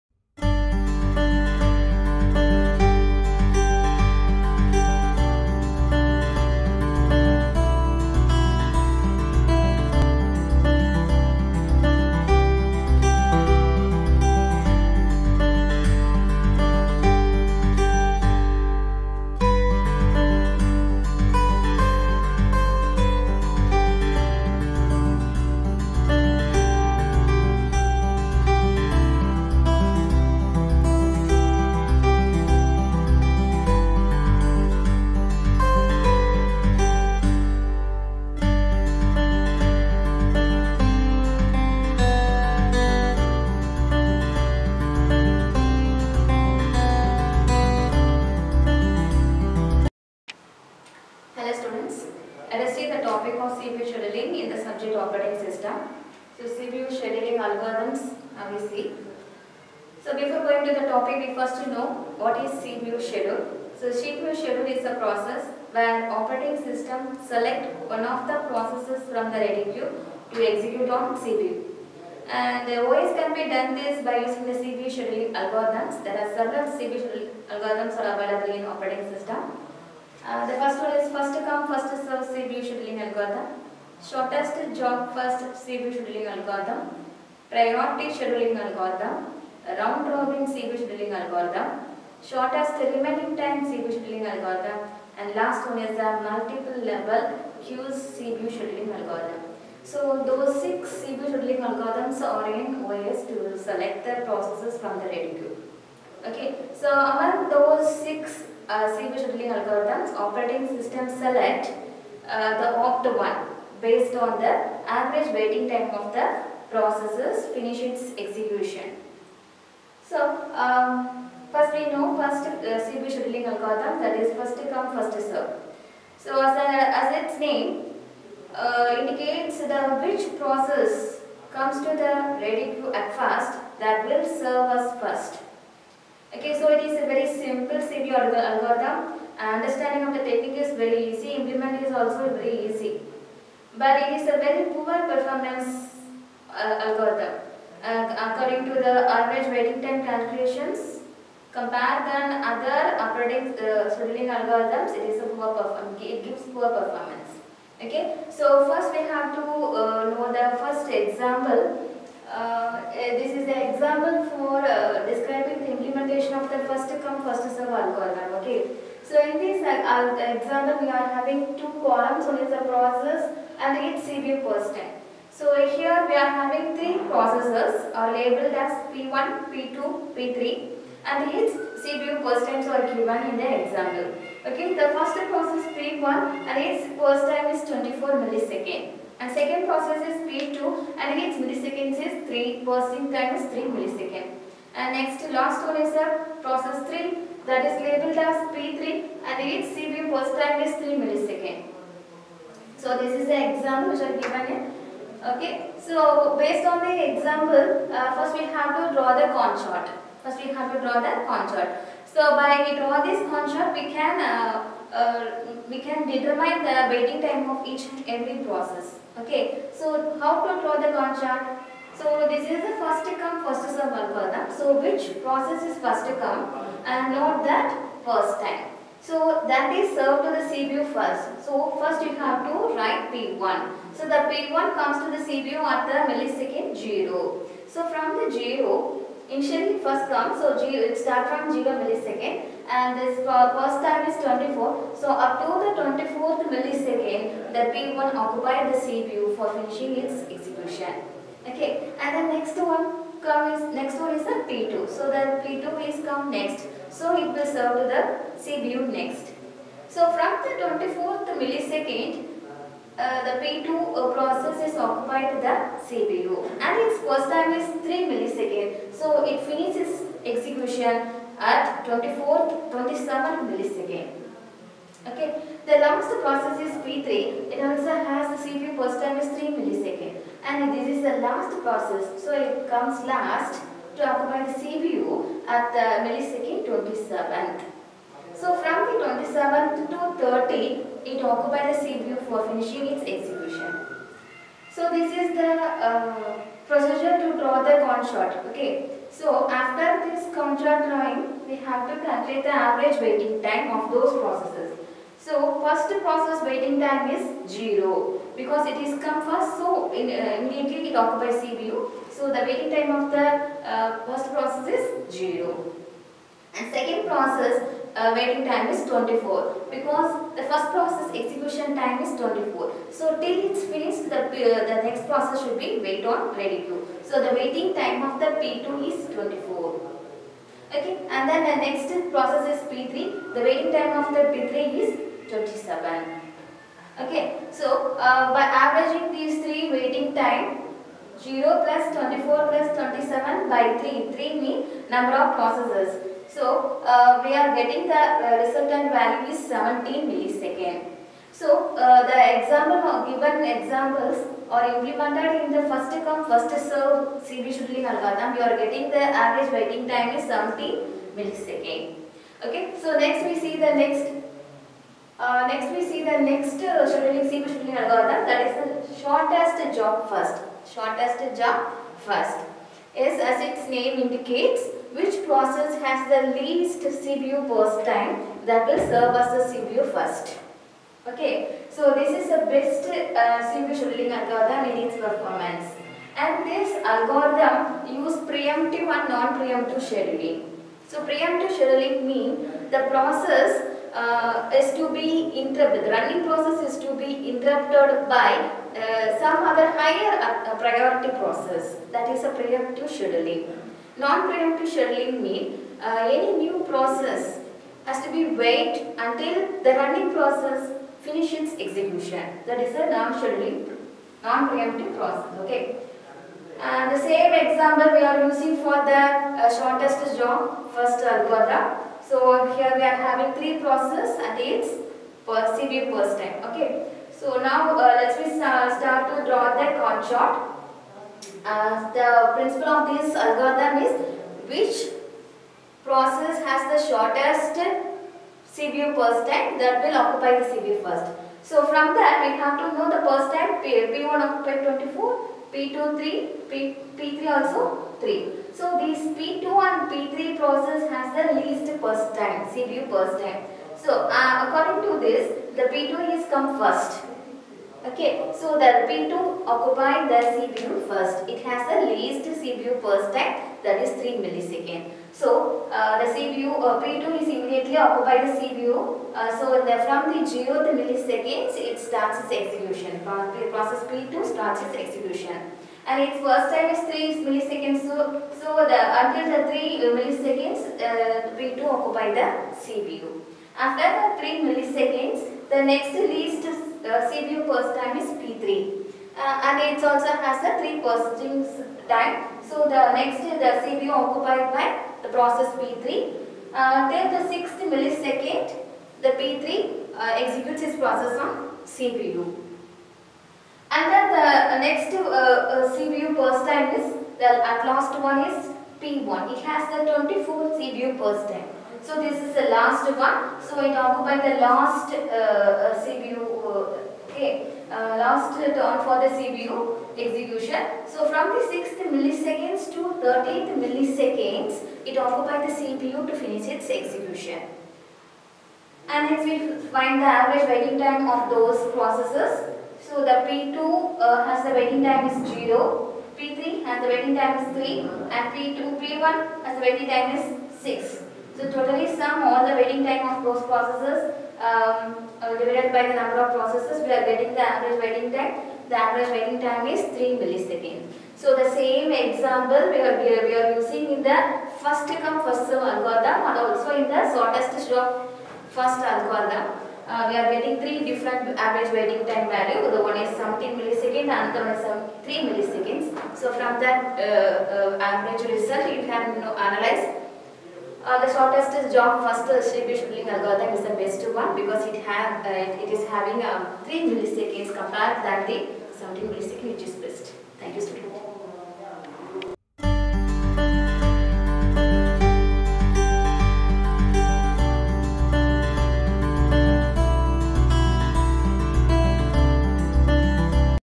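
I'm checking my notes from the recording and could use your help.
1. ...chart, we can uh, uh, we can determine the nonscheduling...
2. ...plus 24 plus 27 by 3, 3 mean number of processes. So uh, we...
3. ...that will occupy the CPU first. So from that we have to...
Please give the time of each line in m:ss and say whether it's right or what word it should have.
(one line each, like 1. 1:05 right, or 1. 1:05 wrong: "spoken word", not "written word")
1. 3:33 wrong: "waiting", not "nonscheduling"
2. 5:41 right
3. 7:19 right.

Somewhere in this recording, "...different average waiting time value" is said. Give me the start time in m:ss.
9:20.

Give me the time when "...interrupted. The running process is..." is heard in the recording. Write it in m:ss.
6:35.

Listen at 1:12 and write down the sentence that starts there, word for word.
And the uh, OS can be done this by using the CPU scheduling algorithms.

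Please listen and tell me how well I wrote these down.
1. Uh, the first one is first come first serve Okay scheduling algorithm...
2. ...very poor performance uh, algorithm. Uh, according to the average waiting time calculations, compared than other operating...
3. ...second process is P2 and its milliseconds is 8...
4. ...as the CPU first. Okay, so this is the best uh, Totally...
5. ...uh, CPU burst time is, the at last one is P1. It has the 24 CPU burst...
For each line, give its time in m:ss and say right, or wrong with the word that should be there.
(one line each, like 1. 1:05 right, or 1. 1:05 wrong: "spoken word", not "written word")
1. 1:20 wrong: "CPU", not "Okay"
2. 2:24 right
3. 3:09 wrong: "3", not "8"
4. 6:19 wrong: "CPU", not "Totally"
5. 8:25 right.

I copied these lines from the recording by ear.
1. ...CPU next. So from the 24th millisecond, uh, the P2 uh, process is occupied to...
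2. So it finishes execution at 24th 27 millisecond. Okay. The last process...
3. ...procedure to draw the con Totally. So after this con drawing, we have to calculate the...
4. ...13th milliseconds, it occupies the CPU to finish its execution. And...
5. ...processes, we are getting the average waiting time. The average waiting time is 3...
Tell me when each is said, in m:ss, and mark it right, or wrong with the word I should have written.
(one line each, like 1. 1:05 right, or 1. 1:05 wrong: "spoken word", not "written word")
1. 4:18 right
2. 4:28 right
3. 4:56 wrong: "Okay", not "Totally"
4. 8:42 right
5. 9:06 right.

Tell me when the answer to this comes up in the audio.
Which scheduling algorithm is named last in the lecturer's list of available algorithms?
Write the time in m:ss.
1:36.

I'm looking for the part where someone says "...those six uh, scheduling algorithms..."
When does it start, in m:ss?
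1:47.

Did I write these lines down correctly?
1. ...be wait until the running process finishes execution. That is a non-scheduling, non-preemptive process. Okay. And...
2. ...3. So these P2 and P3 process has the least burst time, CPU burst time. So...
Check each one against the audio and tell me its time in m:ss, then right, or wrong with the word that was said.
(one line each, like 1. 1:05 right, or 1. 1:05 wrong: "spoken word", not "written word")
1. 6:48 right
2. 7:27 right.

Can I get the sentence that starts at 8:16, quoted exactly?
Uh, then the sixth millisecond, the P3 uh, executes its process on CPU.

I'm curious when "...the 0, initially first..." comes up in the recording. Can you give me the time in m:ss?
3:58.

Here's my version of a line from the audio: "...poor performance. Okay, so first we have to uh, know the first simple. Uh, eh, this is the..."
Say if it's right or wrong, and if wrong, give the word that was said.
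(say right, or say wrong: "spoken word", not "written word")
wrong: "example", not "simple".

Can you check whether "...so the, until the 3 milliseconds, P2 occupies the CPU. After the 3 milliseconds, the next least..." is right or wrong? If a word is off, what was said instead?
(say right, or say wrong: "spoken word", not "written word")
right.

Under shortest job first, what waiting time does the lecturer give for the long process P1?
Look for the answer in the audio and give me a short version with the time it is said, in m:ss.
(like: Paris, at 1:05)
6, at 9:00.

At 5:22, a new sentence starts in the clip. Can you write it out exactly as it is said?
So till it's finished the, uh, the next process should be wait on ready queue.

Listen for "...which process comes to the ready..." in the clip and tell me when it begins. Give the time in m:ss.
2:10.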